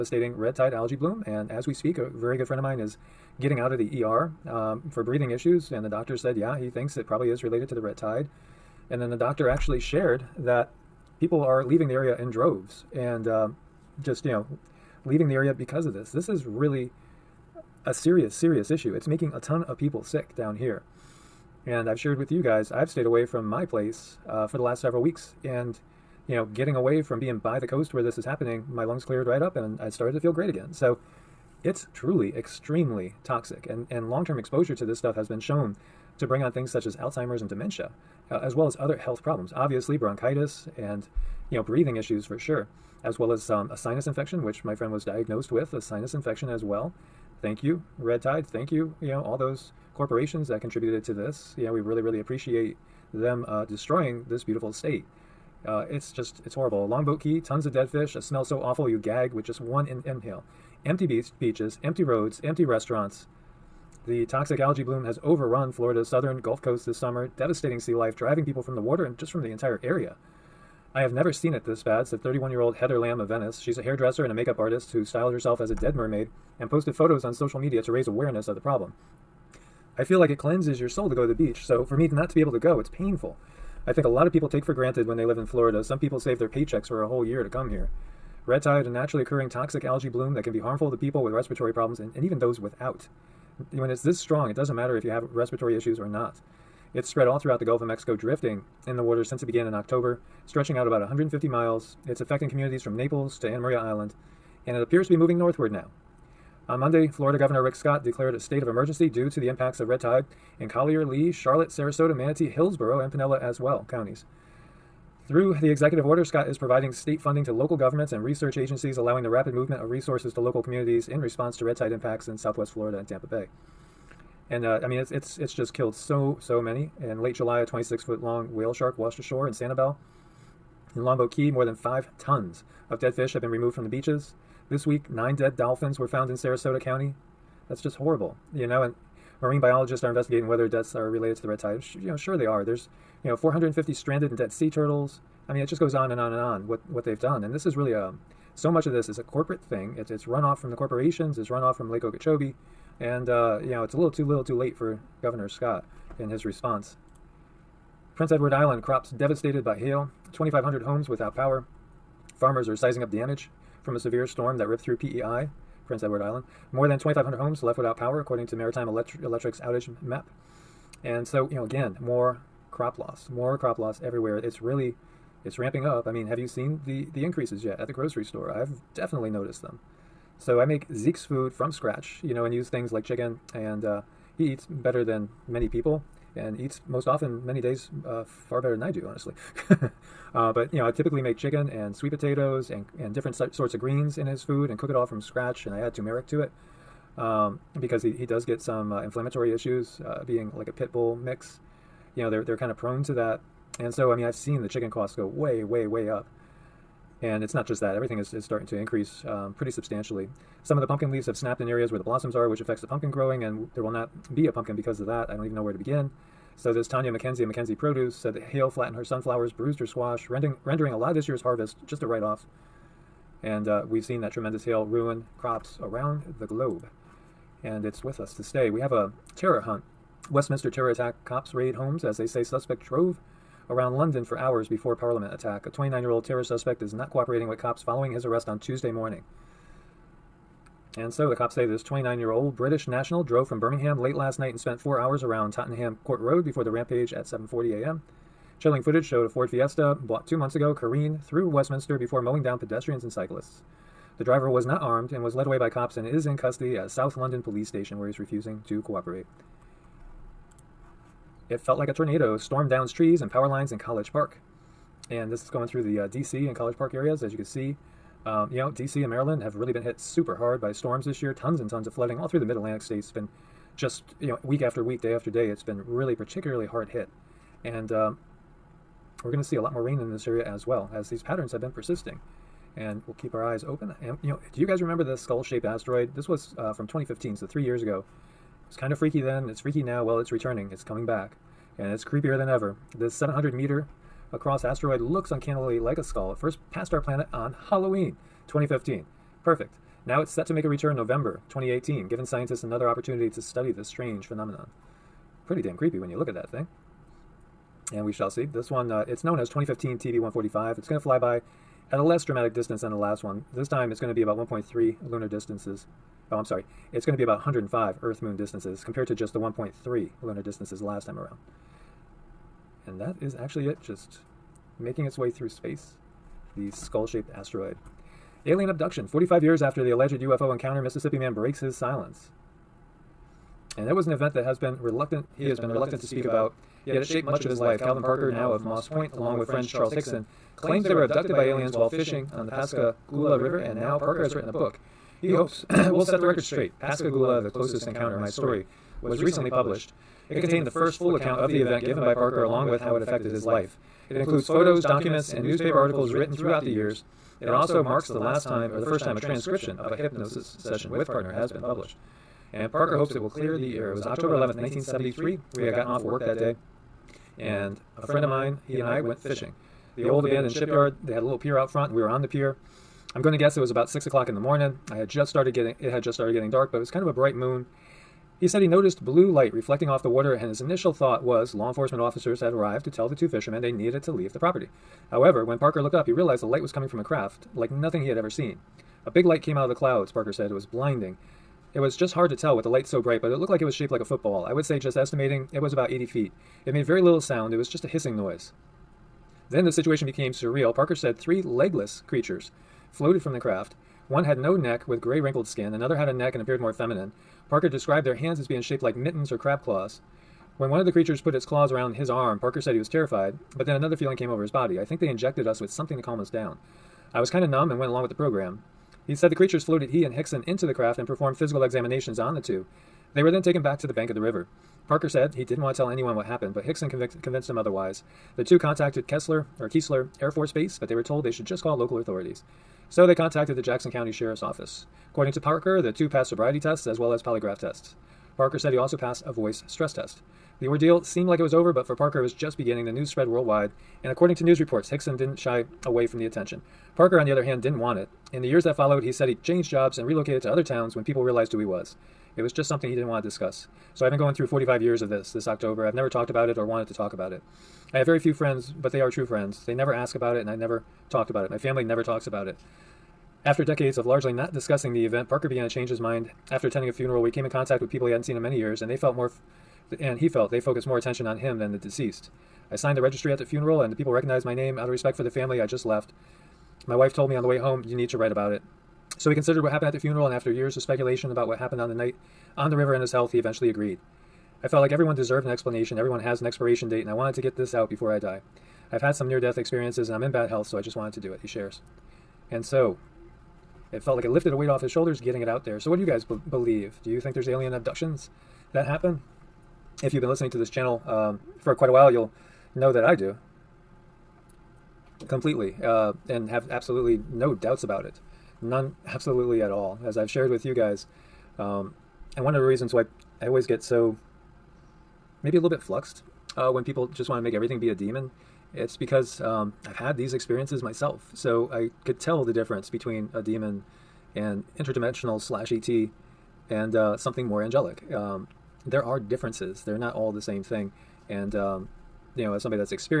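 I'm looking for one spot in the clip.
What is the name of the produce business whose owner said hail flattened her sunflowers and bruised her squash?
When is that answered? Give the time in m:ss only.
3:37.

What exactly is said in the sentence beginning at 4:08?
Chilling footage showed a Ford Fiesta bought two months ago careen through Westminster before mowing down pedestrians and cyclists.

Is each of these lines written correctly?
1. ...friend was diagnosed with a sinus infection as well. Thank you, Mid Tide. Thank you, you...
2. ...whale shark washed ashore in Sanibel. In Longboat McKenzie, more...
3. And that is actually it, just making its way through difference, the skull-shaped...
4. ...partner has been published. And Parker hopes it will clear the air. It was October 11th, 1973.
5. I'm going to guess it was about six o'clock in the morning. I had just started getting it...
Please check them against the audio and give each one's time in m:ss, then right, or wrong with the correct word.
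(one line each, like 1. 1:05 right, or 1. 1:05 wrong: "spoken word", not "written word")
1. 0:44 wrong: "Red", not "Mid"
2. 2:08 wrong: "Key", not "McKenzie"
3. 5:22 wrong: "space", not "difference"
4. 6:01 right
5. 6:13 right.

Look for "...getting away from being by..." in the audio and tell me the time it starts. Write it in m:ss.
0:26.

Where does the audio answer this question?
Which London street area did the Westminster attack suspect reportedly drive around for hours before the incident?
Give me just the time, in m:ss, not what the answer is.
4:05.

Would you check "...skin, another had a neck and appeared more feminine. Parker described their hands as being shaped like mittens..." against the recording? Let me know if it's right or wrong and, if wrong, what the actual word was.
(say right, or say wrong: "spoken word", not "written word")
right.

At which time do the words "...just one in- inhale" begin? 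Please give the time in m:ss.
0:59.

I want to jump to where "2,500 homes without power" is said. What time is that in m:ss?
2:40.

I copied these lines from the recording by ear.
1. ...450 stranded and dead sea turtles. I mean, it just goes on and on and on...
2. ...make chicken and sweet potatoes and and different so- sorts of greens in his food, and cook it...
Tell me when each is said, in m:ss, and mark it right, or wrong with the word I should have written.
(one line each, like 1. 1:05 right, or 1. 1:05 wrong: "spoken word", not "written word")
1. 2:23 right
2. 3:11 right.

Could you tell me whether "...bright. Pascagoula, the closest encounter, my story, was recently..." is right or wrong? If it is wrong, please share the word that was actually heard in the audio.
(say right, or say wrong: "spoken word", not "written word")
wrong: "straight", not "bright".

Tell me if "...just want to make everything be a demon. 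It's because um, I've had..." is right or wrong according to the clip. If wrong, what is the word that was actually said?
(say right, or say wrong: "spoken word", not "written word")
right.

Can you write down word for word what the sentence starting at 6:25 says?
However, when Parker looked up, he realized the light was coming from a craft like nothing he had ever seen.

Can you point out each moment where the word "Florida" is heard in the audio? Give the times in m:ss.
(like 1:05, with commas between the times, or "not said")
1:05, 1:25, 1:47, 2:02.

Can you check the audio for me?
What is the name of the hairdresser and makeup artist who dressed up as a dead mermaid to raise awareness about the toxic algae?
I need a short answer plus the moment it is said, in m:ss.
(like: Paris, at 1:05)
Heather Lamb, at 1:12.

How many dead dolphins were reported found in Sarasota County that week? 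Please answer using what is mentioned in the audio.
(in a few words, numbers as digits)
9.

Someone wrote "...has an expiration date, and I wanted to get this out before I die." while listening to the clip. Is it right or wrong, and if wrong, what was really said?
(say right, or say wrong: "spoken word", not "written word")
right.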